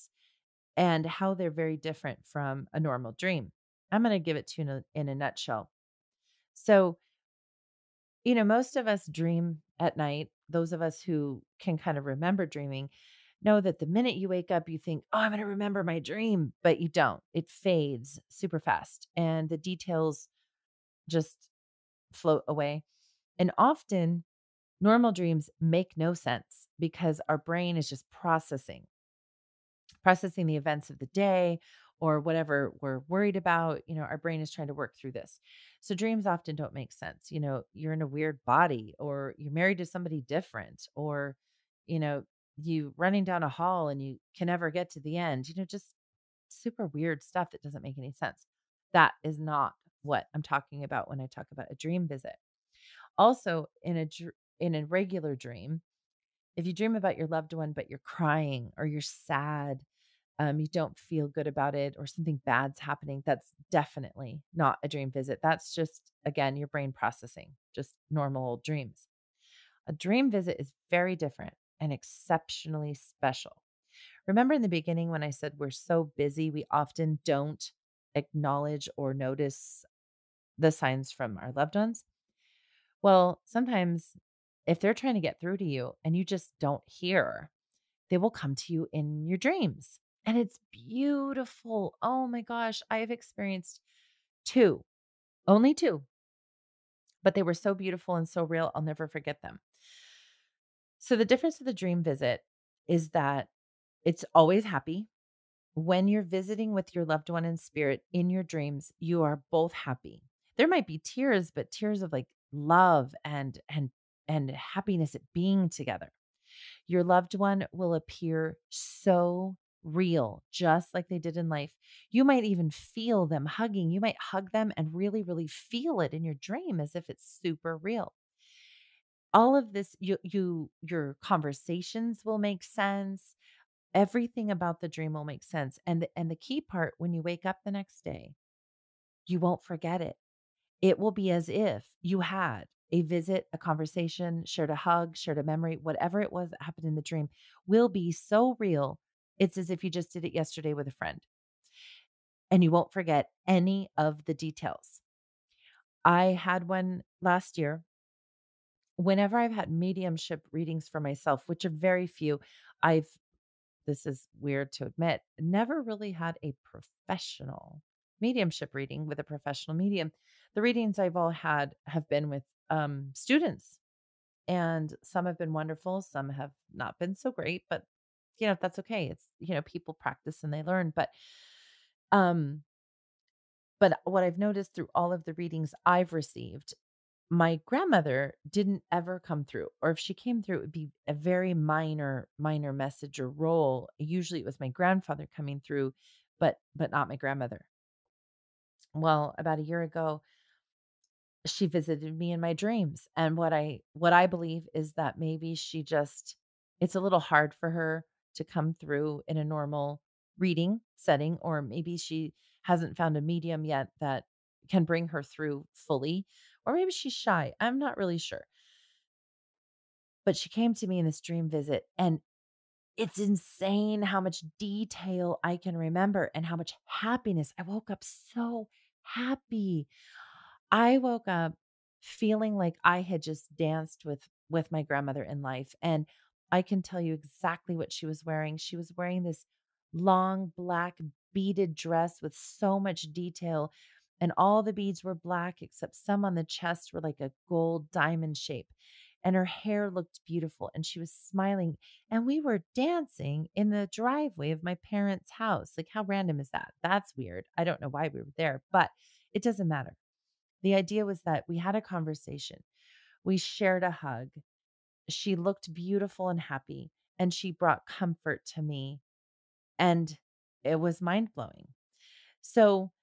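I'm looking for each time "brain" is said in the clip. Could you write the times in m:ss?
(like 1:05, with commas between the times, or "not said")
0:27, 0:34, 1:06.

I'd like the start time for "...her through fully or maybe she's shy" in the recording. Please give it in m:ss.
3:35.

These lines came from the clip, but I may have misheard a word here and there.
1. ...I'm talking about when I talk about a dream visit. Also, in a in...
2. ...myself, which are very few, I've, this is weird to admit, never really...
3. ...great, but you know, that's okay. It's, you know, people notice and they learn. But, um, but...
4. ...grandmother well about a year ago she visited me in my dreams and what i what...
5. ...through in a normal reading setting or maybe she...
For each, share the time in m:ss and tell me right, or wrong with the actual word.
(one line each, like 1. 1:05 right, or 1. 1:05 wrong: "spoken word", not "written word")
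1. 0:50 right
2. 2:40 right
3. 2:57 wrong: "practice", not "notice"
4. 3:17 right
5. 3:28 right.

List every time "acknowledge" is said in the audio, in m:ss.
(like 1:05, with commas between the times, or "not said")
1:18.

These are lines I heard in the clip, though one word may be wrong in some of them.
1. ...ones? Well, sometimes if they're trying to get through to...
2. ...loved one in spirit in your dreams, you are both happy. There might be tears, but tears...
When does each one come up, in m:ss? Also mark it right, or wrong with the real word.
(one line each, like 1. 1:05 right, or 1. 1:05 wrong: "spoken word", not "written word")
1. 1:21 right
2. 1:47 right.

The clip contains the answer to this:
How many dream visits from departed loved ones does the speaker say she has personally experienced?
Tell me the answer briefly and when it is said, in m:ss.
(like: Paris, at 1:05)
2, at 1:34.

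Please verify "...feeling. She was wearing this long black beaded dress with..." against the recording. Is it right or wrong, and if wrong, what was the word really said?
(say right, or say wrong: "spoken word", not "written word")
wrong: "wearing", not "feeling".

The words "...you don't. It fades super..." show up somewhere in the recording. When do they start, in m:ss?
0:16.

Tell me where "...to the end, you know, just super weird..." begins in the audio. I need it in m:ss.
0:44.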